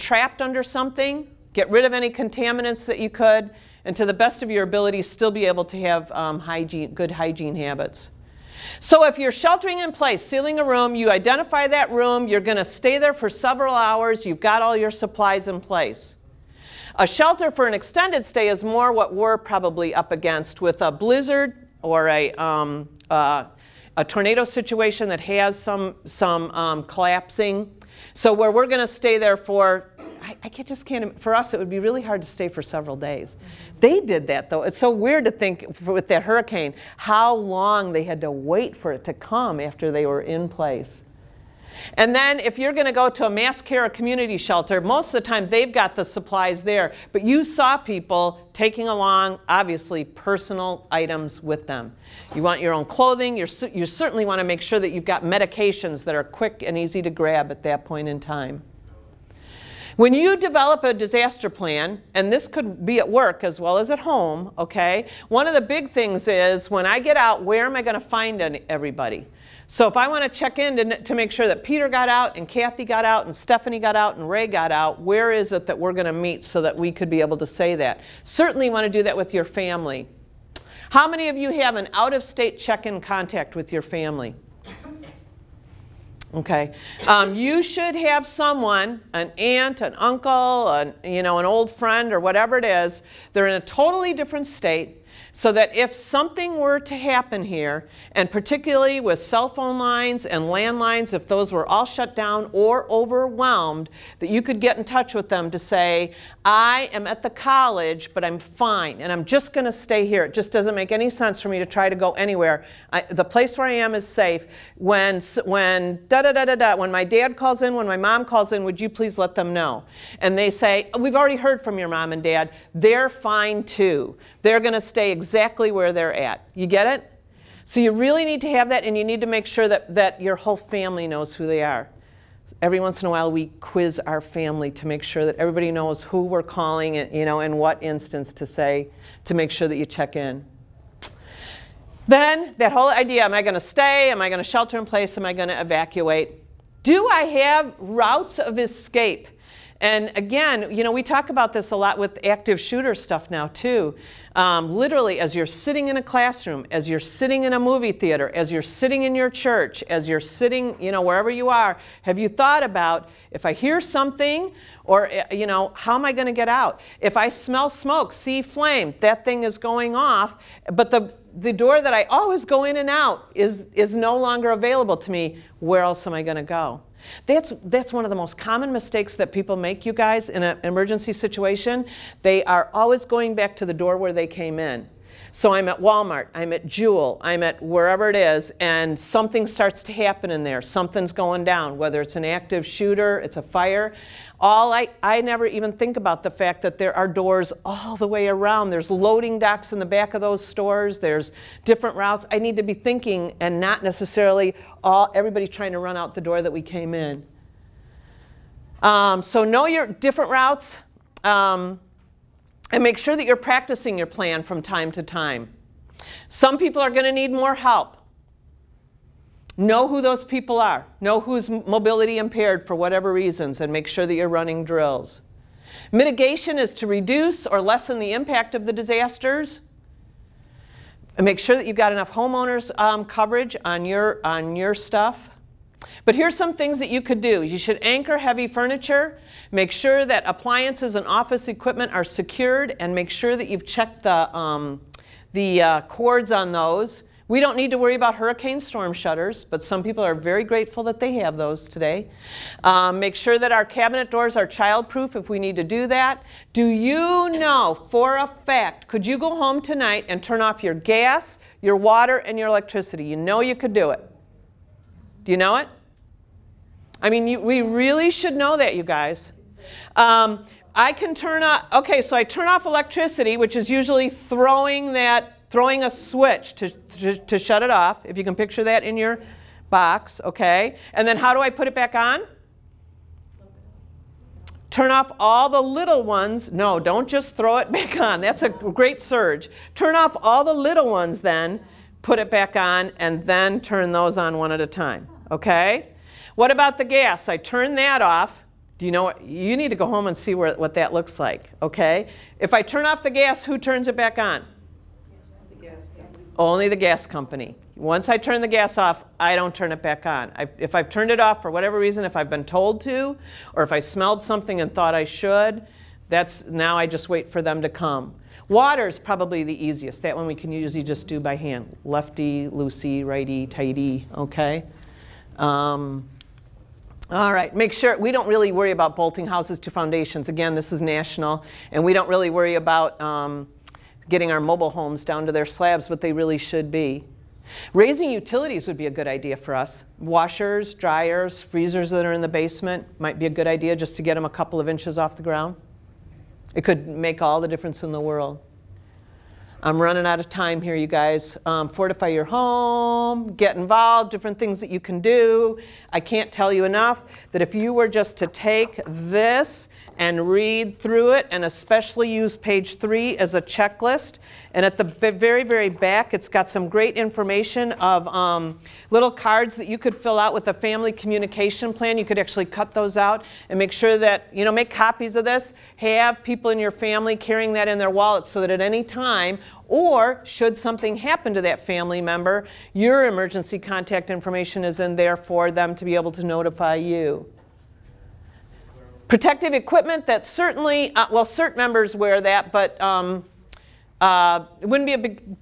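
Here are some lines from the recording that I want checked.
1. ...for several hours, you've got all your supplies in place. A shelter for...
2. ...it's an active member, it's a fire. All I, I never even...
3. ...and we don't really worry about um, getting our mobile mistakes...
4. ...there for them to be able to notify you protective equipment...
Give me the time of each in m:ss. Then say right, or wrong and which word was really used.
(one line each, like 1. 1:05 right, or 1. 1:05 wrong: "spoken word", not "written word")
1. 0:13 right
2. 3:12 wrong: "shooter", not "member"
3. 5:31 wrong: "homes", not "mistakes"
4. 6:24 right.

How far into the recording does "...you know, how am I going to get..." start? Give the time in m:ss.
2:45.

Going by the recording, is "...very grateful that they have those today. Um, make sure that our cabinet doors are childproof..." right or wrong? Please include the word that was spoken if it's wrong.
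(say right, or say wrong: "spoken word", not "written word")
right.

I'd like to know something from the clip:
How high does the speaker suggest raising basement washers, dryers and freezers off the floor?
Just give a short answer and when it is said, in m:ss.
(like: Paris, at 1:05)
A couple of inches, at 5:44.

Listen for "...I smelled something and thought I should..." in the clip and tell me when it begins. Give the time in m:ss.
5:13.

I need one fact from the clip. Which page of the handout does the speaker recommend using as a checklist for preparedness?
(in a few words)
Page three.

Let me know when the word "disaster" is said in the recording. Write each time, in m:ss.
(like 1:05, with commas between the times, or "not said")
1:00, 3:48.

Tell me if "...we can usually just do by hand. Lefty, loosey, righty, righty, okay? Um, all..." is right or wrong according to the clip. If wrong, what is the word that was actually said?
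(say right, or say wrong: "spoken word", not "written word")
wrong: "tighty", not "righty".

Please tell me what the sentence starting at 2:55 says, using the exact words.
Where else am I going to go?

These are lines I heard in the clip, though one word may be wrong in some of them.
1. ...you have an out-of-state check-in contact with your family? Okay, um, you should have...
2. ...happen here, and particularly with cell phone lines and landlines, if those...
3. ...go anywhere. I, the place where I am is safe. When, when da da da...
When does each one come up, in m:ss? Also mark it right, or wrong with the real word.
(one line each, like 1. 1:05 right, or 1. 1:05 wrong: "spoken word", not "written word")
1. 1:21 right
2. 1:36 right
3. 1:51 right.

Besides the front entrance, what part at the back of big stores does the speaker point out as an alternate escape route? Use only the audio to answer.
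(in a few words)
Loading docks.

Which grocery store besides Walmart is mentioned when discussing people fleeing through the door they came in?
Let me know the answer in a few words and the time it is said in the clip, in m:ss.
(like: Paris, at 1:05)
Jewel, at 3:06.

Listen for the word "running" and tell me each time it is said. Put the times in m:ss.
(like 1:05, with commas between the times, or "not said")
3:44, 5:49.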